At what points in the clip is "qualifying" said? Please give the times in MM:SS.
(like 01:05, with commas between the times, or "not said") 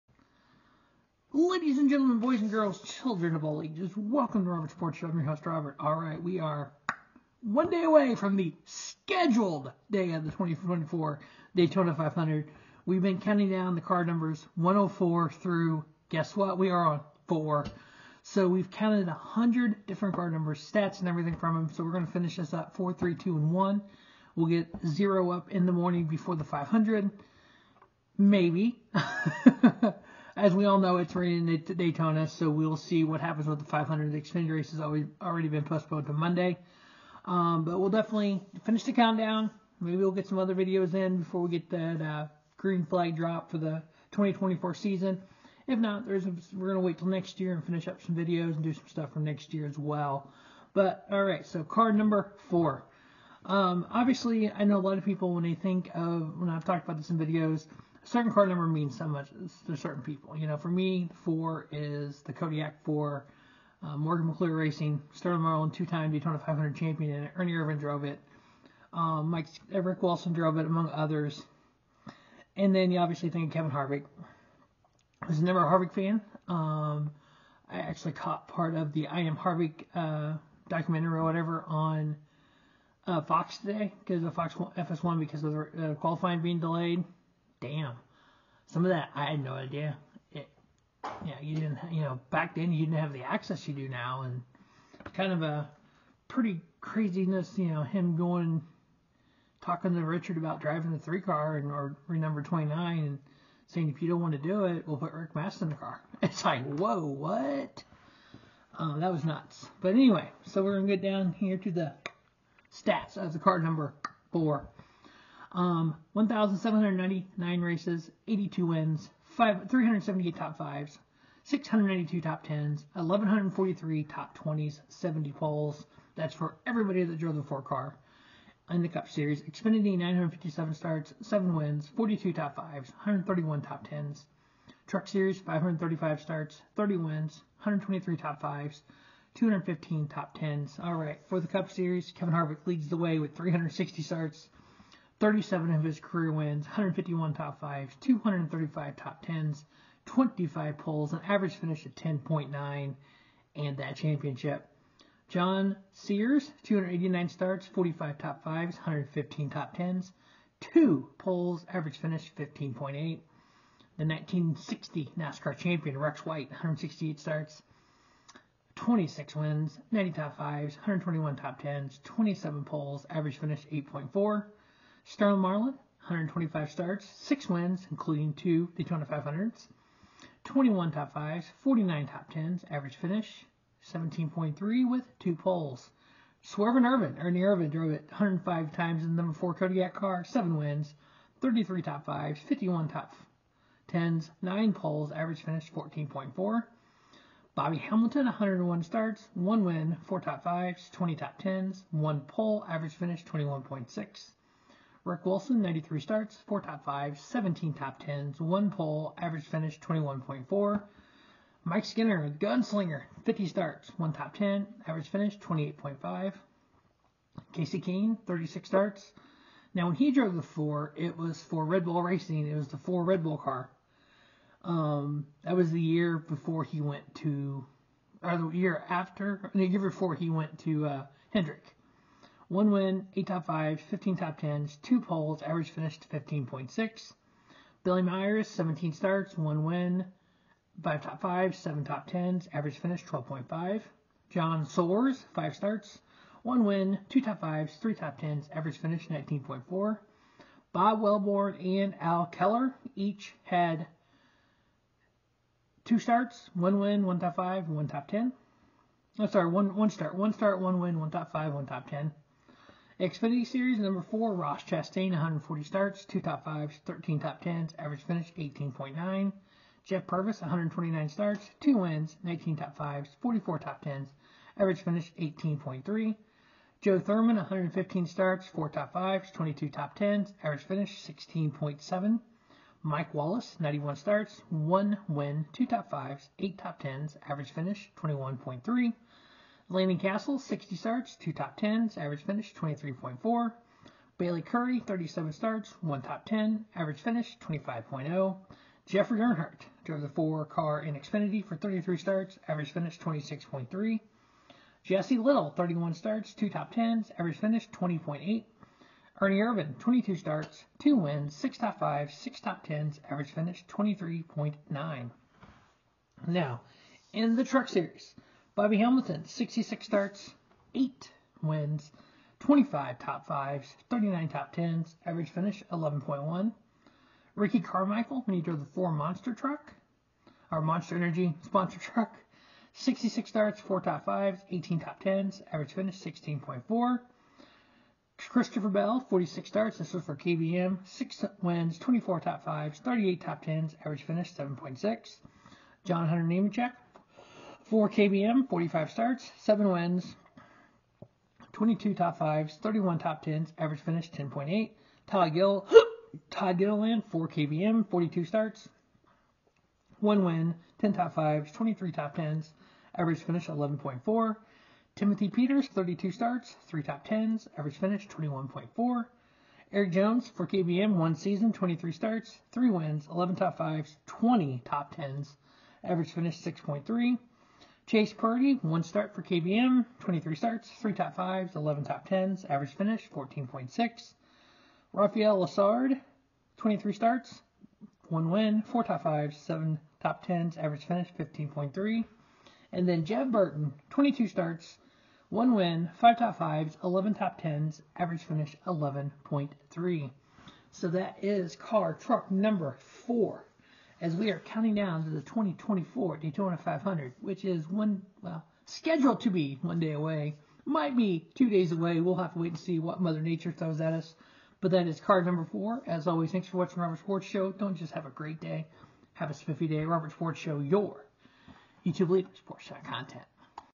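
01:25.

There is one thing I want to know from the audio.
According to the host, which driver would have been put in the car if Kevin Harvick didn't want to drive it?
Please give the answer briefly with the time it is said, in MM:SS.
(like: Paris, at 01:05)
Rick Mast, at 01:45.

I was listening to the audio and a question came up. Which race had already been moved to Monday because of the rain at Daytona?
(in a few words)
Xfinity race.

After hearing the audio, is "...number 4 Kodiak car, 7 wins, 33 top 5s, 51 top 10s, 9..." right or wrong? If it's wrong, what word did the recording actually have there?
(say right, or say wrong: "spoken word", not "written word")
right.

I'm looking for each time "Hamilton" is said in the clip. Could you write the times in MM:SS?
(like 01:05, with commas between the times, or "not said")
03:17, 05:18.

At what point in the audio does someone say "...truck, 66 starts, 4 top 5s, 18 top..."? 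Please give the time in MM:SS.
05:31.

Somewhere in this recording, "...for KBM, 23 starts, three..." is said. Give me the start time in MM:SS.
06:19.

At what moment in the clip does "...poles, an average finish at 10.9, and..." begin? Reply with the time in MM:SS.
02:30.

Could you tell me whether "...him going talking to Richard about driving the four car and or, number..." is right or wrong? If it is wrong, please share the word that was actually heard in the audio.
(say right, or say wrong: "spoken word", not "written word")
wrong: "three", not "four".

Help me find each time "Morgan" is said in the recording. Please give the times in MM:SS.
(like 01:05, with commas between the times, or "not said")
01:03.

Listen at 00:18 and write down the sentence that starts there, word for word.
So we've counted 100 different car numbers, stats, and everything from them.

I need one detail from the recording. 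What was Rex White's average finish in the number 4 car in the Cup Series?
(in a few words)
8.4.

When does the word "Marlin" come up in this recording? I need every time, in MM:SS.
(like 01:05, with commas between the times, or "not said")
01:05, 02:55.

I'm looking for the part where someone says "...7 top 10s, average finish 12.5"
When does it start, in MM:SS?
04:01.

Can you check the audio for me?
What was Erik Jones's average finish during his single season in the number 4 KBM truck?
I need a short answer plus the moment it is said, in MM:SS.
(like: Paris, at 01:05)
6.3, at 06:15.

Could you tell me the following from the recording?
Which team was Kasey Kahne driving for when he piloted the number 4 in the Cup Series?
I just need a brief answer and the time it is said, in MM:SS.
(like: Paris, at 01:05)
Red Bull Racing, at 03:41.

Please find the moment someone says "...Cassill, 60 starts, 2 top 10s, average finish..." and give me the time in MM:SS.
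04:49.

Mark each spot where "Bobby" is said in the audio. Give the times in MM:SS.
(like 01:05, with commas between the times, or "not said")
03:17, 05:18.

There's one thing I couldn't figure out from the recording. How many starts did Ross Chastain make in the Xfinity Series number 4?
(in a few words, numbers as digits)
140.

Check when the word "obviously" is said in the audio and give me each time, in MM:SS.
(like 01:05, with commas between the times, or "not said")
00:53, 01:12.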